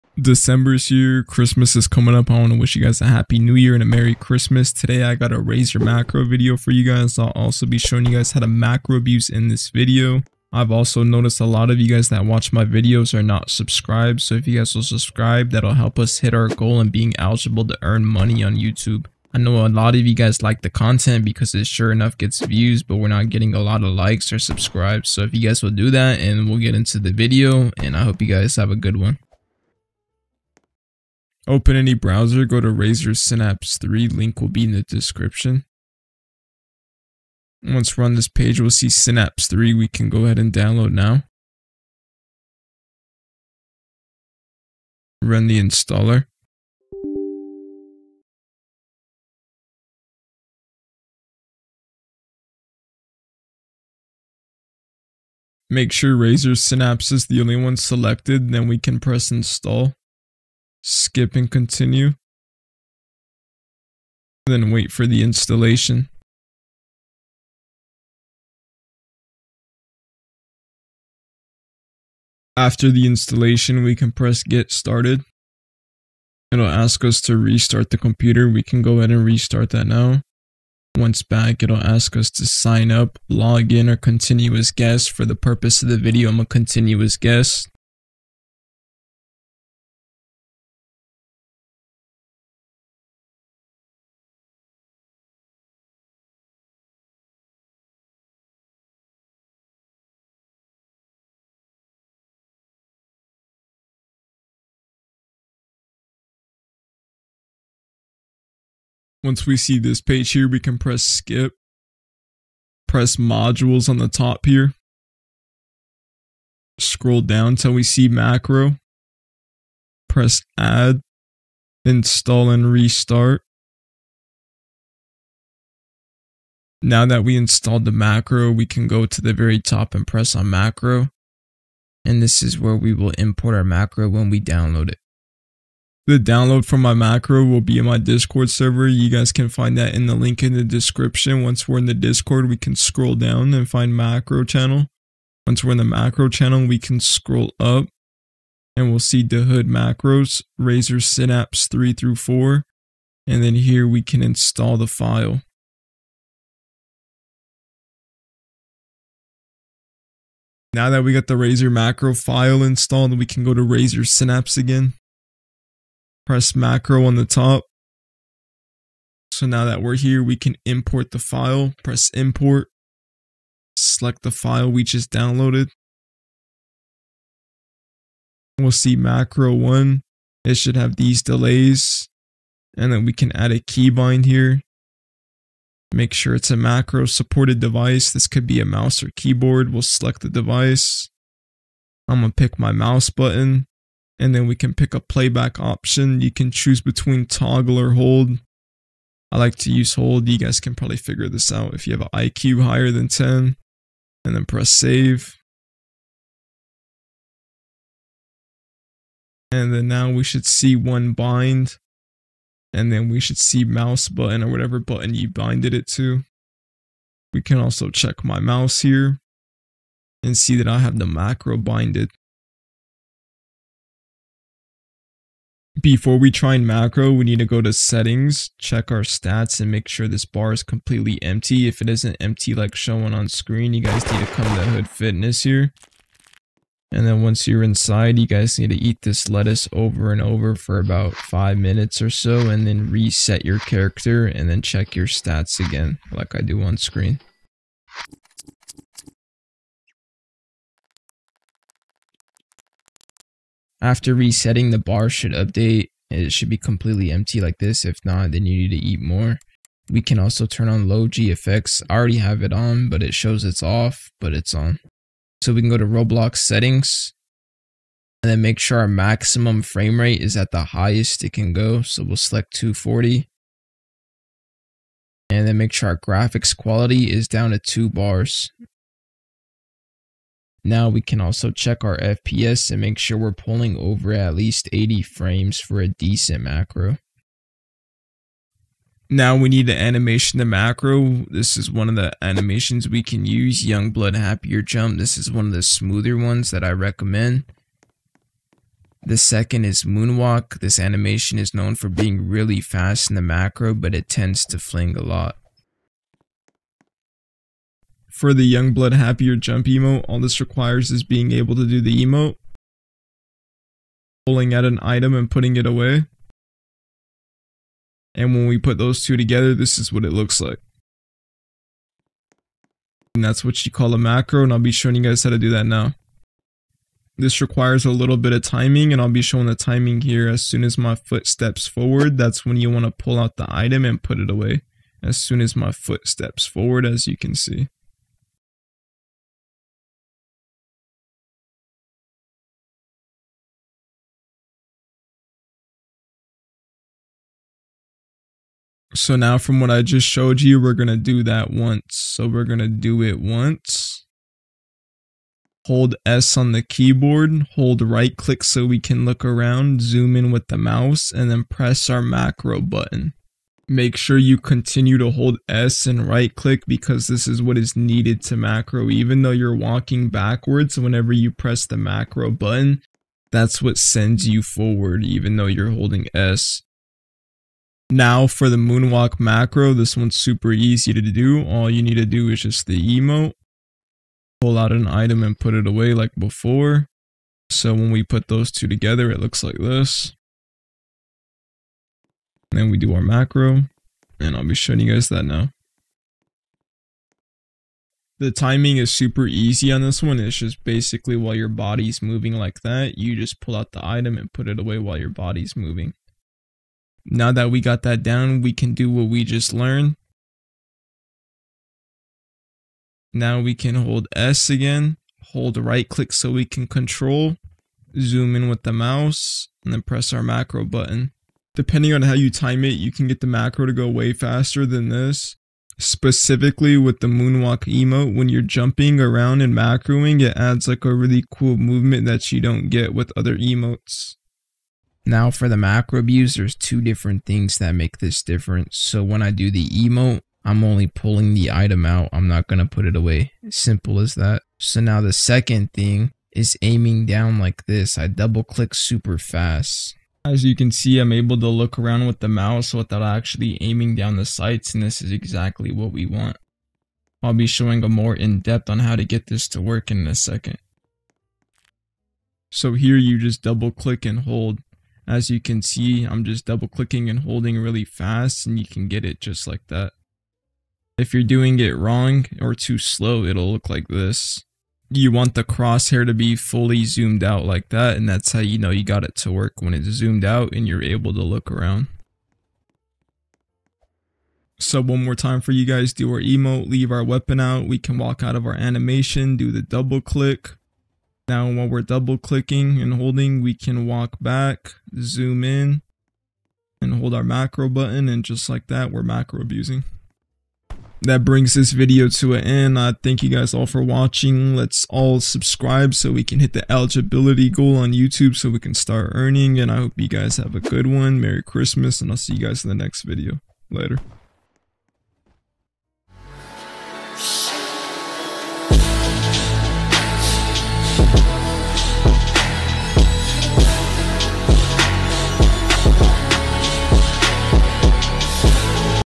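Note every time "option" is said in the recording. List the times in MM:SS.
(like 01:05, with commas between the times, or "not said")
03:15.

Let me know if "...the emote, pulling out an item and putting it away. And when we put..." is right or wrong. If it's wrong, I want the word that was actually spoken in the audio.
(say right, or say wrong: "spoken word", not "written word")
right.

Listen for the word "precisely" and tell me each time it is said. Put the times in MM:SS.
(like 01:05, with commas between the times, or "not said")
not said.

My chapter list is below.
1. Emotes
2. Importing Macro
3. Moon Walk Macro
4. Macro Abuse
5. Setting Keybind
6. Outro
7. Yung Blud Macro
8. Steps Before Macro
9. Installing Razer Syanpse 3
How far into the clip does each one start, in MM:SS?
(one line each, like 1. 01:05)
1. 04:49
2. 02:15
3. 06:17
4. 07:14
5. 03:00
6. 08:20
7. 05:07
8. 03:45
9. 00:30.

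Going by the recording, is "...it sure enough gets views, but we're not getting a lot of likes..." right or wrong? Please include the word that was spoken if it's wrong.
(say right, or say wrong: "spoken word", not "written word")
right.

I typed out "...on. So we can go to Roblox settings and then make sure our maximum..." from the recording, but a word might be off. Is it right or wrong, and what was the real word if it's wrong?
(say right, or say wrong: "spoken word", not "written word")
right.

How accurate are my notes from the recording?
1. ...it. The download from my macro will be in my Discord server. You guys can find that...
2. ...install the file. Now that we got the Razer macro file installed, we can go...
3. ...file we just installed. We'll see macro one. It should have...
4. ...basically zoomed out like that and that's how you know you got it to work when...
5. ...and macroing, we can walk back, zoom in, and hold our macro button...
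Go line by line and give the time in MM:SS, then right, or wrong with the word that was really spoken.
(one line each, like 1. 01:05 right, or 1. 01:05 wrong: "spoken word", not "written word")
1. 02:14 right
2. 02:34 right
3. 02:54 wrong: "downloaded", not "installed"
4. 07:56 wrong: "fully", not "basically"
5. 08:12 wrong: "holding", not "macroing".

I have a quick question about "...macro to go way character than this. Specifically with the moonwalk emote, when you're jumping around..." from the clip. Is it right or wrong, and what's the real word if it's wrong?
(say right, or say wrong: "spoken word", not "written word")
wrong: "faster", not "character".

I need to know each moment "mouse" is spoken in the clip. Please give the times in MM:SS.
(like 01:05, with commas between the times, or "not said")
03:08, 03:12, 03:33, 03:38, 06:00, 06:58, 07:32.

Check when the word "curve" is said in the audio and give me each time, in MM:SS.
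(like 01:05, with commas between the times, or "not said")
not said.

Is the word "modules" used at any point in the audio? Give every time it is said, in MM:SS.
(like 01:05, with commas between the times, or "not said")
01:53.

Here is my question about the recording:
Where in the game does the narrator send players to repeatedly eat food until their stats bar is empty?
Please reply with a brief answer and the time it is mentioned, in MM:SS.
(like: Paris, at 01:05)
Hood Fitness, at 03:54.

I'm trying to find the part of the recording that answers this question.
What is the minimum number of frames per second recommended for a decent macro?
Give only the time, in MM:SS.
04:44.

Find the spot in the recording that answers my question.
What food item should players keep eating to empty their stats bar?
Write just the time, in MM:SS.
03:59.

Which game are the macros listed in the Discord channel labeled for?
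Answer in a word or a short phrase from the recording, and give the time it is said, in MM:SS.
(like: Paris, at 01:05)
Da Hood, at 02:29.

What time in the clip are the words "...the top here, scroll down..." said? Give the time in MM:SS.
01:53.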